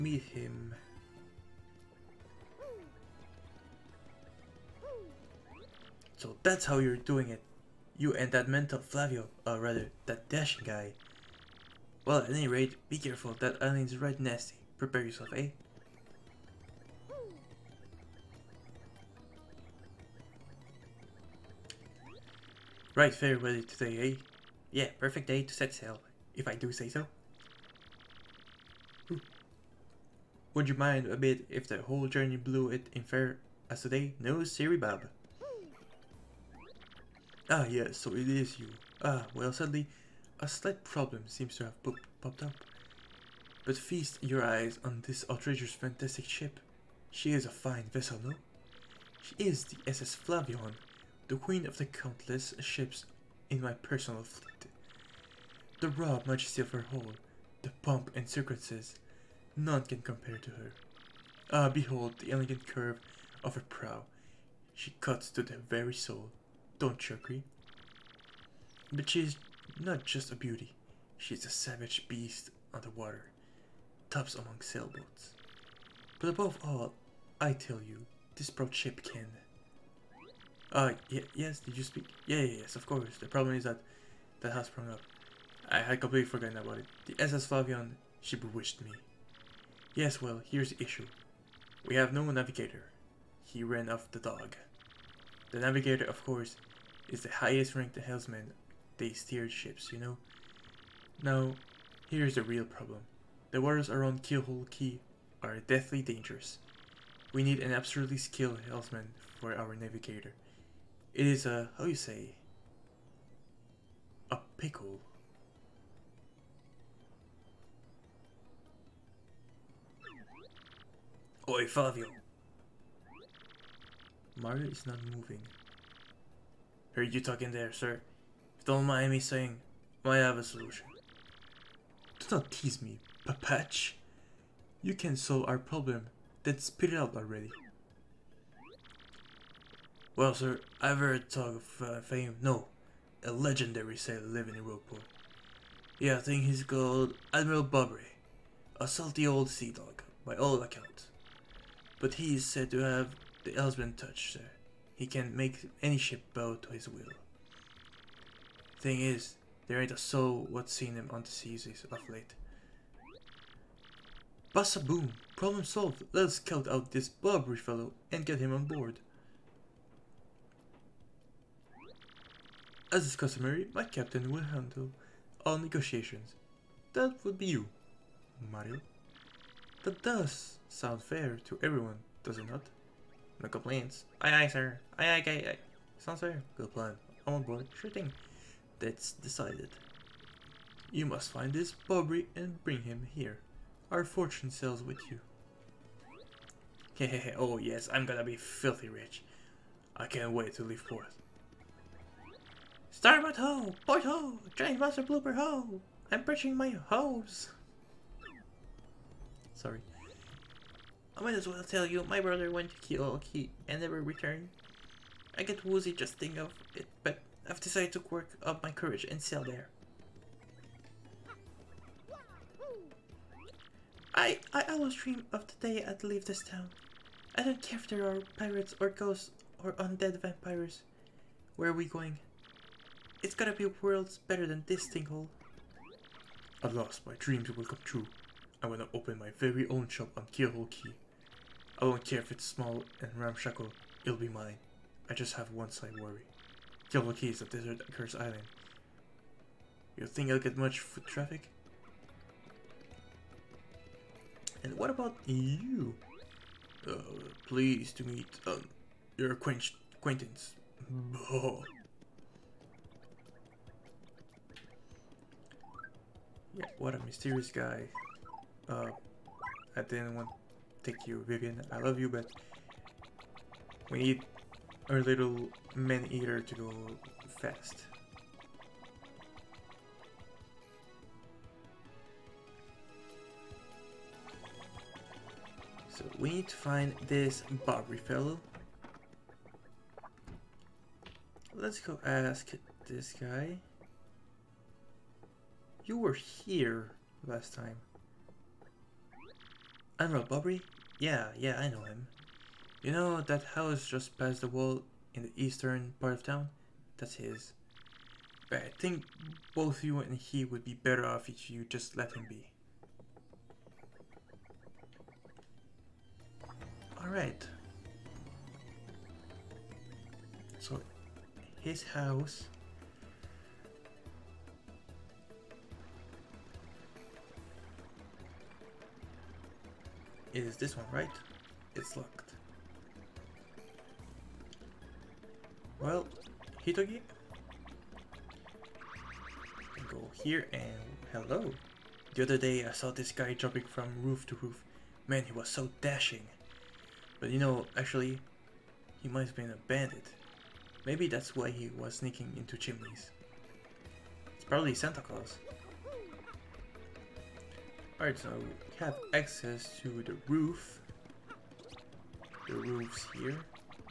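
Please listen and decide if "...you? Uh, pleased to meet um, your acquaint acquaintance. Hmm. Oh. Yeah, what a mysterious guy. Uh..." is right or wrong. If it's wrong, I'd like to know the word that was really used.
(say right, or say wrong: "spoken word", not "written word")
right.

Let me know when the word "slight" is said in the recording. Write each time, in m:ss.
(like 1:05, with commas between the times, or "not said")
0:40, 4:05.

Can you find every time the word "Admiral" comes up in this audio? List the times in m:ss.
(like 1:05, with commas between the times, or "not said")
2:27, 4:59.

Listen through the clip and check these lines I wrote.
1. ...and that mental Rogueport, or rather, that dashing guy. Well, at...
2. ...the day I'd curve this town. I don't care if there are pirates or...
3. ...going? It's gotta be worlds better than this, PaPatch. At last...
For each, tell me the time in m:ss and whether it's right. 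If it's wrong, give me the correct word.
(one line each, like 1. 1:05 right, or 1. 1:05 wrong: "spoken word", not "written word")
1. 0:08 wrong: "Flavio", not "Rogueport"
2. 3:45 wrong: "leave", not "curve"
3. 3:51 wrong: "Tingle", not "PaPatch".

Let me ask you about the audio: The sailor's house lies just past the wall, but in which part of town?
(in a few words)
Eastern part.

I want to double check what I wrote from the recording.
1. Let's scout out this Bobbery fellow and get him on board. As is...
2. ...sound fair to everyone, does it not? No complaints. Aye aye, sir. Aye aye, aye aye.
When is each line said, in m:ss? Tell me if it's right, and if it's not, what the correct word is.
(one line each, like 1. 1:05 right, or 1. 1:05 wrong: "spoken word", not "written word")
1. 2:46 right
2. 3:00 right.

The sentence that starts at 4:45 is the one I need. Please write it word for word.
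So we need to find this Bobbery fellow.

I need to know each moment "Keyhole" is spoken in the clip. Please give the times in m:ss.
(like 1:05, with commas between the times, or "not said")
4:00, 4:06.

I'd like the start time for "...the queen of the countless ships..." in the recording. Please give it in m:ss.
0:51.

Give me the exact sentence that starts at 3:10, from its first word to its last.
You must find this Bobbery and bring him here.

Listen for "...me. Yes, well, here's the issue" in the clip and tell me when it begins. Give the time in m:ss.
1:28.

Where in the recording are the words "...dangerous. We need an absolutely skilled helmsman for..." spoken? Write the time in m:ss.
1:46.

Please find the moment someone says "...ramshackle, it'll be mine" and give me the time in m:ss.
4:03.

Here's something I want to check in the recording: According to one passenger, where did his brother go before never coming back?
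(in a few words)
Kiolki.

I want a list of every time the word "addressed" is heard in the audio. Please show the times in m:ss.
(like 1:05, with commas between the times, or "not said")
not said.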